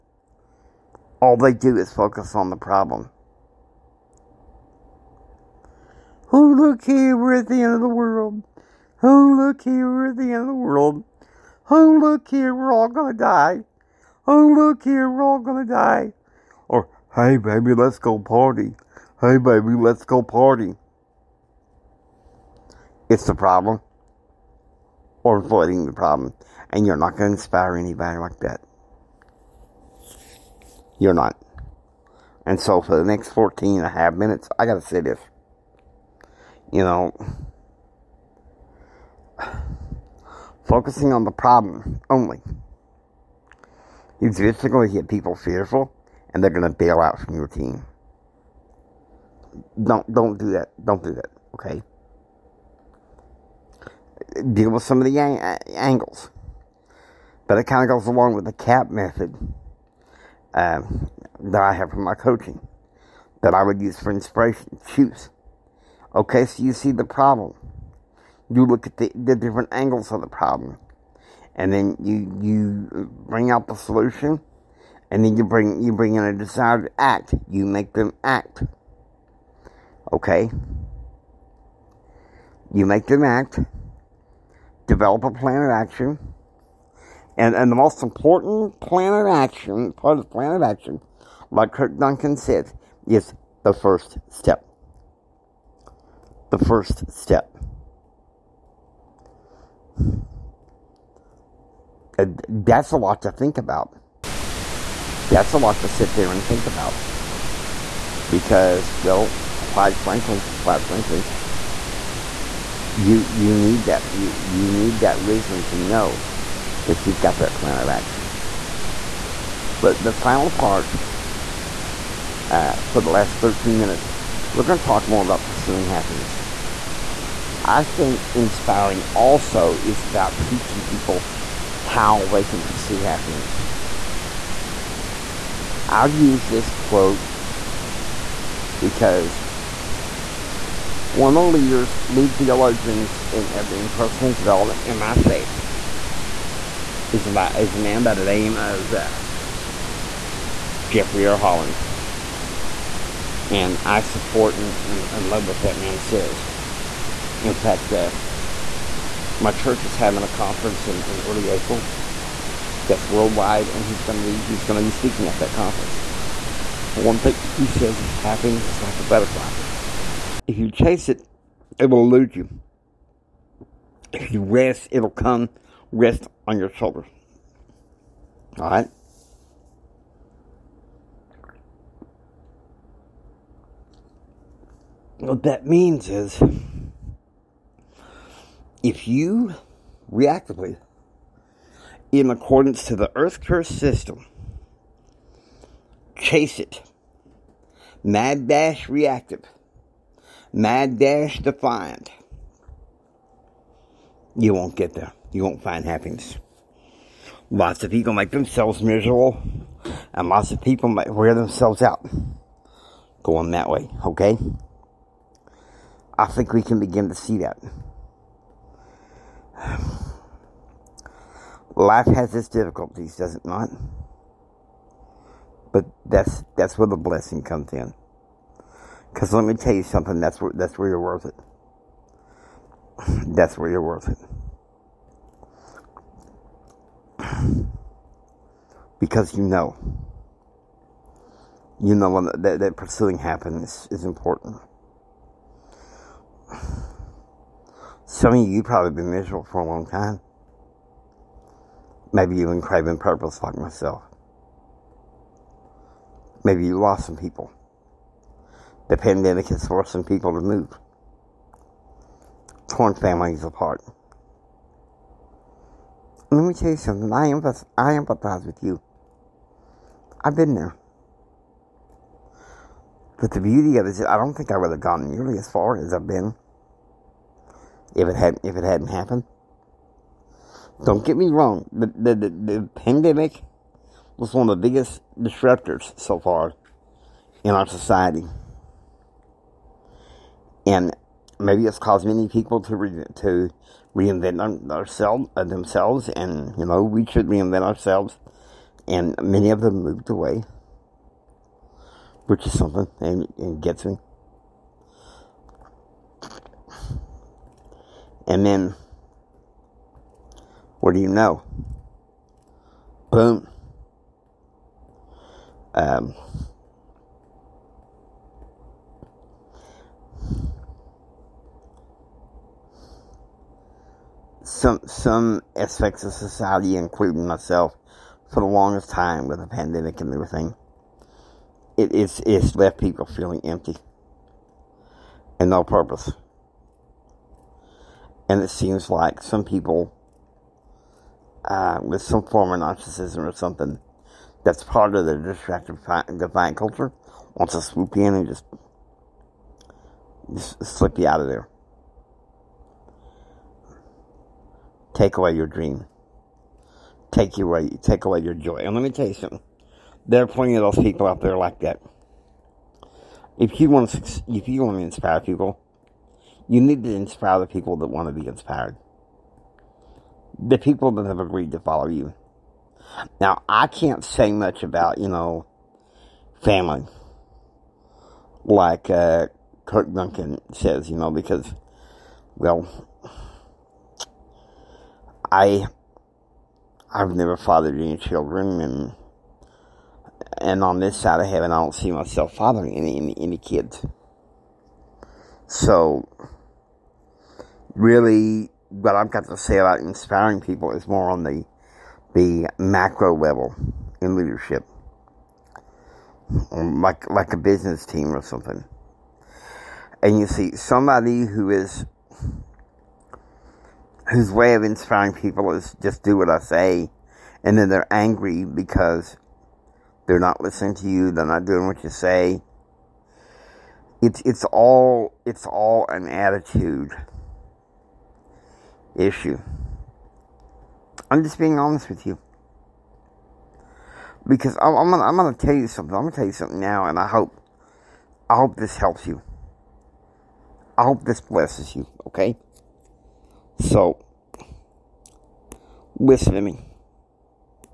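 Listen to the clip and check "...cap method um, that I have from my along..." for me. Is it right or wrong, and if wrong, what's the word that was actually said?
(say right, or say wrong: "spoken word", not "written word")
wrong: "coaching", not "along".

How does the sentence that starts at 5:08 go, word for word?
And then, what do you know?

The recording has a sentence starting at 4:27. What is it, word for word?
I empathize, I empathize with you.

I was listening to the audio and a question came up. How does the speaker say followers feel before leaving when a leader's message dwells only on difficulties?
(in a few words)
fearful.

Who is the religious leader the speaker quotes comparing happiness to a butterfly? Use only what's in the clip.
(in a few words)
Jeffrey R. Holland.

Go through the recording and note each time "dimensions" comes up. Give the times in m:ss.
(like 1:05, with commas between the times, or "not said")
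not said.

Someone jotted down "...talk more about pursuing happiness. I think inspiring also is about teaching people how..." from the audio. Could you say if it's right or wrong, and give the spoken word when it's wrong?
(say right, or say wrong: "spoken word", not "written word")
right.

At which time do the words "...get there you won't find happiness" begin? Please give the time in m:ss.
3:24.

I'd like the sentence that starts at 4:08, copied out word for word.
Some of you probably been miserable for a long time.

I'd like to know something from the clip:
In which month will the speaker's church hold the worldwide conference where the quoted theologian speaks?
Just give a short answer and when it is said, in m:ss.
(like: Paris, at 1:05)
April, at 2:41.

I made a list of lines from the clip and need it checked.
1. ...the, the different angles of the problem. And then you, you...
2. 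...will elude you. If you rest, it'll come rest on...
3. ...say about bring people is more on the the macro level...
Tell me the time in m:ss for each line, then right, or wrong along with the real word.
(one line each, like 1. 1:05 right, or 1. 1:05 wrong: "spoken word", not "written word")
1. 1:08 right
2. 2:51 right
3. 6:39 wrong: "inspiring", not "bring".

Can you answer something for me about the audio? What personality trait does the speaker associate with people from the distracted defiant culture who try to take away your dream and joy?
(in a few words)
narcissism.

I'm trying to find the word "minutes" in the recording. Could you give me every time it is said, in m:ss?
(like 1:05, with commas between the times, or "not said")
0:34, 2:03.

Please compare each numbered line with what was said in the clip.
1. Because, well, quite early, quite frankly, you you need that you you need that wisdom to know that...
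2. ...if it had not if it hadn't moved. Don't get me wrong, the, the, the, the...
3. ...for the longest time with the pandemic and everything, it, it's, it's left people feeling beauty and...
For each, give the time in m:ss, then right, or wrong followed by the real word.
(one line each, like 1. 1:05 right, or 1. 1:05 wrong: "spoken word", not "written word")
1. 1:48 wrong: "frankly", not "early"
2. 4:37 wrong: "happened", not "moved"
3. 5:28 wrong: "empty", not "beauty".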